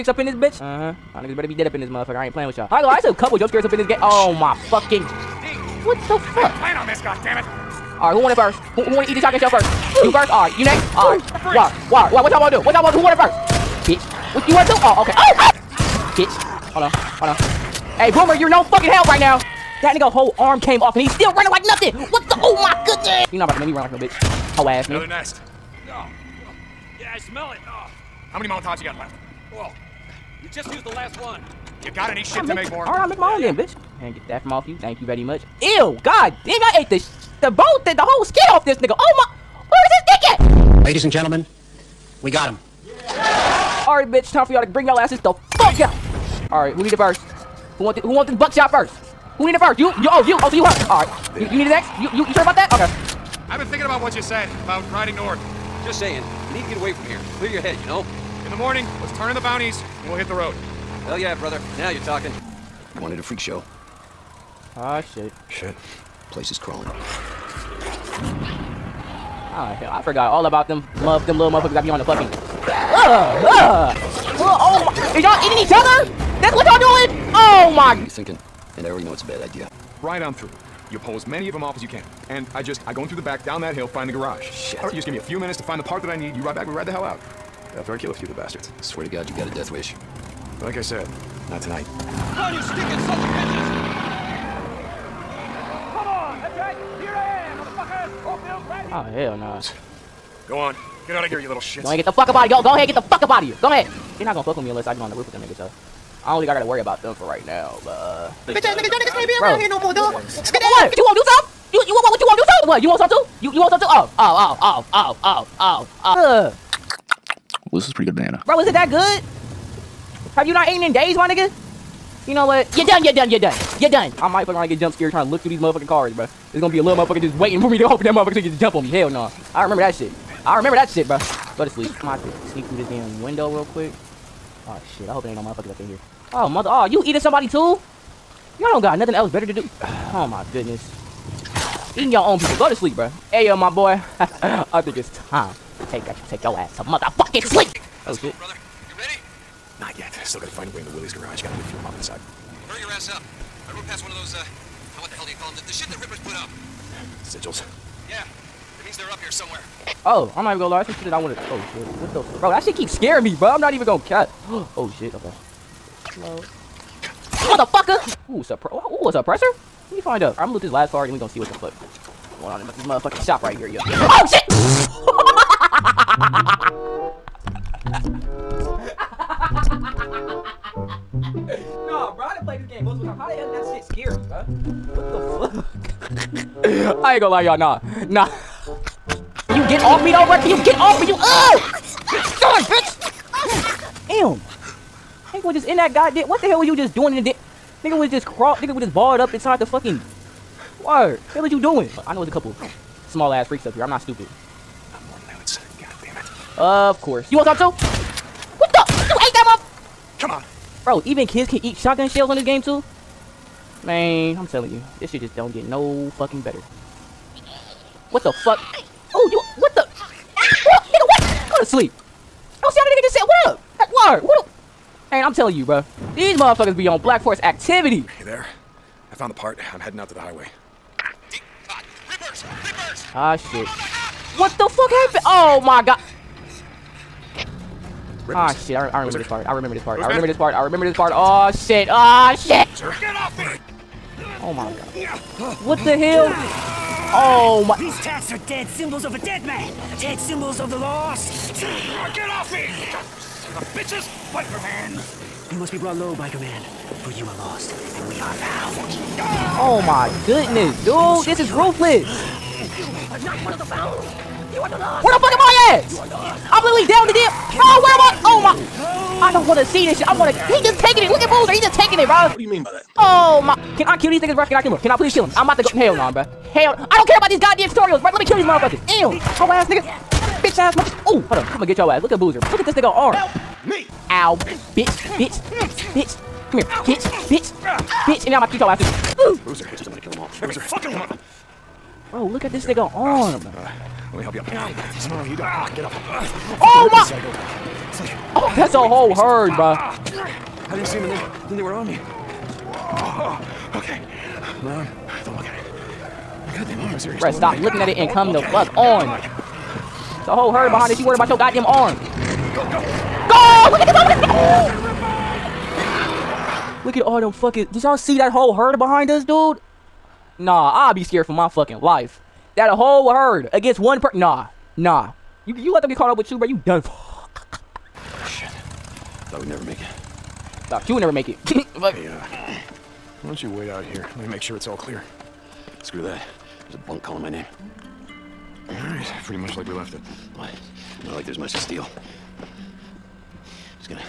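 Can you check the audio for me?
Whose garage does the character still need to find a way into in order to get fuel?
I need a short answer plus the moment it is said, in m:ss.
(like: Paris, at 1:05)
Willie's, at 2:30.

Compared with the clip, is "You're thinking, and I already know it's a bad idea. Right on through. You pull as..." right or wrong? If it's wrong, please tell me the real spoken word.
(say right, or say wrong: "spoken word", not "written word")
right.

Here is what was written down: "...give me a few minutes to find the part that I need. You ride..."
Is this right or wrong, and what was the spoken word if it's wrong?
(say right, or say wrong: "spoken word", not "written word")
right.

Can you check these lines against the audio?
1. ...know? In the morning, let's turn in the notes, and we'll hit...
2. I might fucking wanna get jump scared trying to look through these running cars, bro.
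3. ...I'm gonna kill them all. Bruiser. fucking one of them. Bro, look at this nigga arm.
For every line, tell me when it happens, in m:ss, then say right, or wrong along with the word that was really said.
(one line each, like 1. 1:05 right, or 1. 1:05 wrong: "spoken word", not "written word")
1. 0:57 wrong: "bounties", not "notes"
2. 2:04 wrong: "motherfucking", not "running"
3. 4:49 right.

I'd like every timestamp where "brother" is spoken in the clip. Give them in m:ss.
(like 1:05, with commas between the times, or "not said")
1:01, 2:28.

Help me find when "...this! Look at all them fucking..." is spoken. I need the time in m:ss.
5:16.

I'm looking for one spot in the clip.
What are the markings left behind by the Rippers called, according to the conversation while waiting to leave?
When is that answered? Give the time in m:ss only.
2:37.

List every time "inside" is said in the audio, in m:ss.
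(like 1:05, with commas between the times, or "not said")
2:31, 3:19.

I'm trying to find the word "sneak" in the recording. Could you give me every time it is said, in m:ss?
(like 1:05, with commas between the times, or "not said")
2:12.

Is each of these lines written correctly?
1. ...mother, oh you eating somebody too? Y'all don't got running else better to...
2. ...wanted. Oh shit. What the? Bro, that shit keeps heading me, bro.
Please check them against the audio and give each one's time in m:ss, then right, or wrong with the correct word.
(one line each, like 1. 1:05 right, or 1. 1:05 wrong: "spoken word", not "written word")
1. 2:16 wrong: "nothing", not "running"
2. 2:41 wrong: "scaring", not "heading".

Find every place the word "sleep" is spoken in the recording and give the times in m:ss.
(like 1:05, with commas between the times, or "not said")
2:11, 2:22, 2:27, 3:41.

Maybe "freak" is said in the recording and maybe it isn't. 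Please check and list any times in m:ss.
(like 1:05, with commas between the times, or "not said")
1:03, 3:23.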